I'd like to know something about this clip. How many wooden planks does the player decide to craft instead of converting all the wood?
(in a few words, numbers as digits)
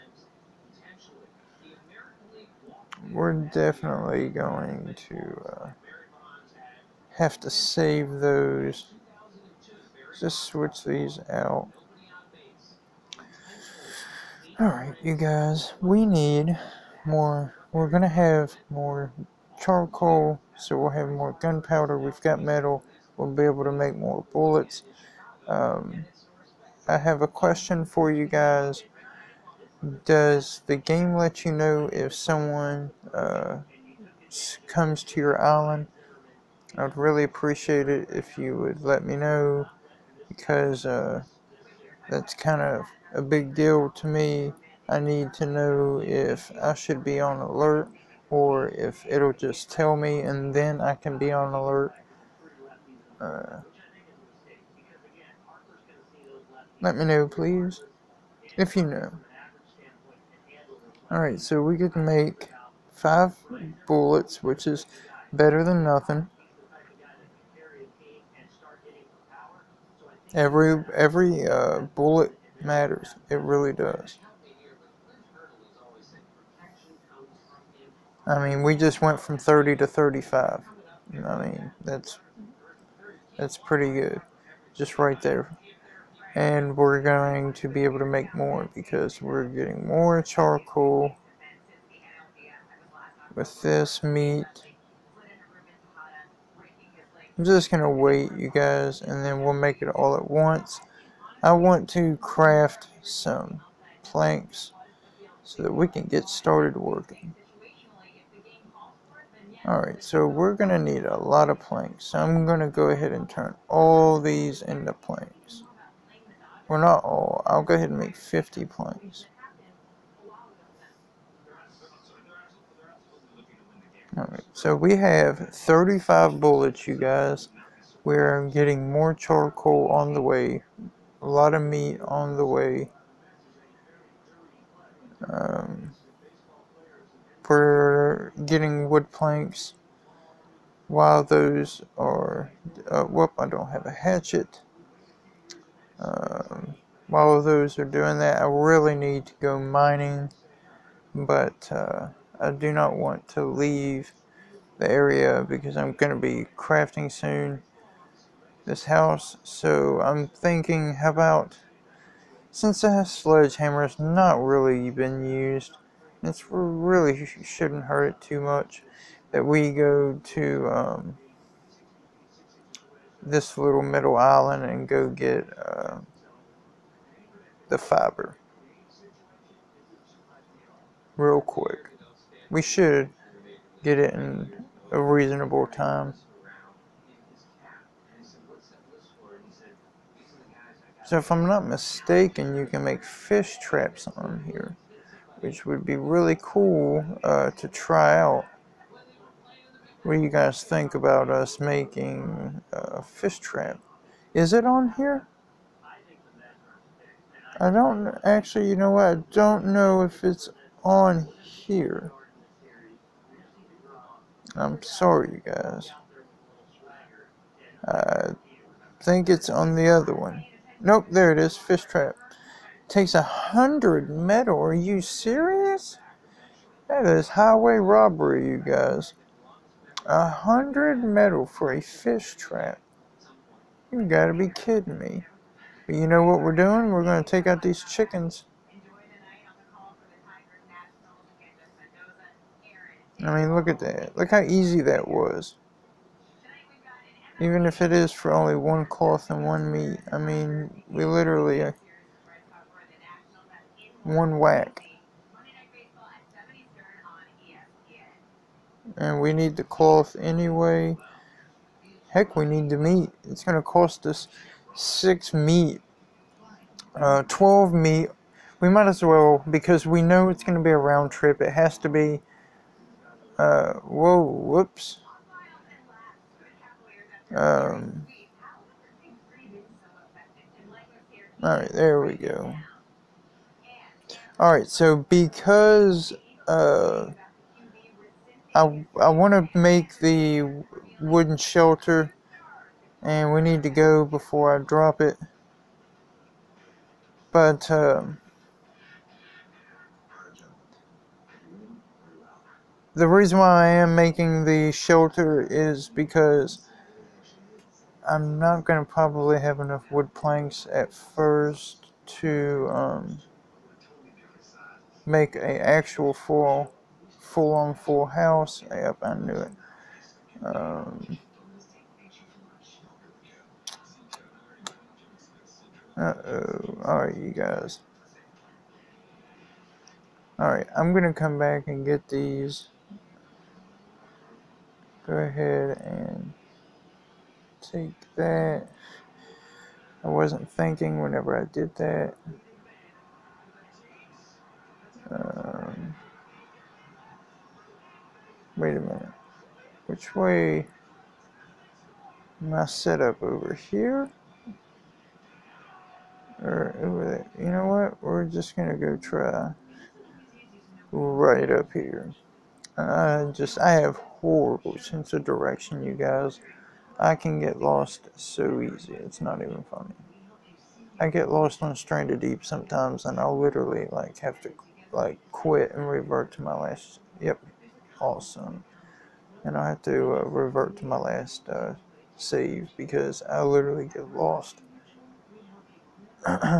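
50.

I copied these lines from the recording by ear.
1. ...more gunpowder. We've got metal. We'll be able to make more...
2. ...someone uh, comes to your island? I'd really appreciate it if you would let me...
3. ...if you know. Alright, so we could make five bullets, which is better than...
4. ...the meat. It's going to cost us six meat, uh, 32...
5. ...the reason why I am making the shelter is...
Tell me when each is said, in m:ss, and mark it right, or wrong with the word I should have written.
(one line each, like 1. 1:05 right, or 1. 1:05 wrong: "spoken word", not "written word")
1. 0:21 right
2. 0:32 right
3. 0:58 right
4. 4:22 wrong: "12", not "32"
5. 5:02 right.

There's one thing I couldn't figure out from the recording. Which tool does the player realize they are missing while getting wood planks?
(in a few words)
hatchet.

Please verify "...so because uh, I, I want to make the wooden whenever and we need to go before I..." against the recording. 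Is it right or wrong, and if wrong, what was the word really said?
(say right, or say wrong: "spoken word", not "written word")
wrong: "shelter", not "whenever".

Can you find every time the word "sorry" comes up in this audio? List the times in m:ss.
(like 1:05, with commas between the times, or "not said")
3:34.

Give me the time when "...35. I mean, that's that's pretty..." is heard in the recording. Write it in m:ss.
1:19.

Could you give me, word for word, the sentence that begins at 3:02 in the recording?
We should get it in a reasonable time.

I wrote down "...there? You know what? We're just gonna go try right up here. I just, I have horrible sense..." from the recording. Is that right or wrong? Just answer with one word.
right.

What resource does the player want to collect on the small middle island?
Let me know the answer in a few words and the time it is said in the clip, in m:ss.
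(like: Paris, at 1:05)
fiber, at 2:57.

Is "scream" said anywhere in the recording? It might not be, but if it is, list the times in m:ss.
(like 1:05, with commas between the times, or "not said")
not said.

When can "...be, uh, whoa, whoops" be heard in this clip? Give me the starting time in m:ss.
4:31.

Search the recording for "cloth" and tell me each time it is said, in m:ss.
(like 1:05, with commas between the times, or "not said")
4:08, 4:19.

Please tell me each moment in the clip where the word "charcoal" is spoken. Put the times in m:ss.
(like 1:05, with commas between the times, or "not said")
0:19, 1:30, 2:09.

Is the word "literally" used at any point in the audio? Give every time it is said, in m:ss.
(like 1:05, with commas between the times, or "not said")
4:11, 6:13, 6:23.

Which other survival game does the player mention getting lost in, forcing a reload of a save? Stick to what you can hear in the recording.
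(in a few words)
Stranded Deep.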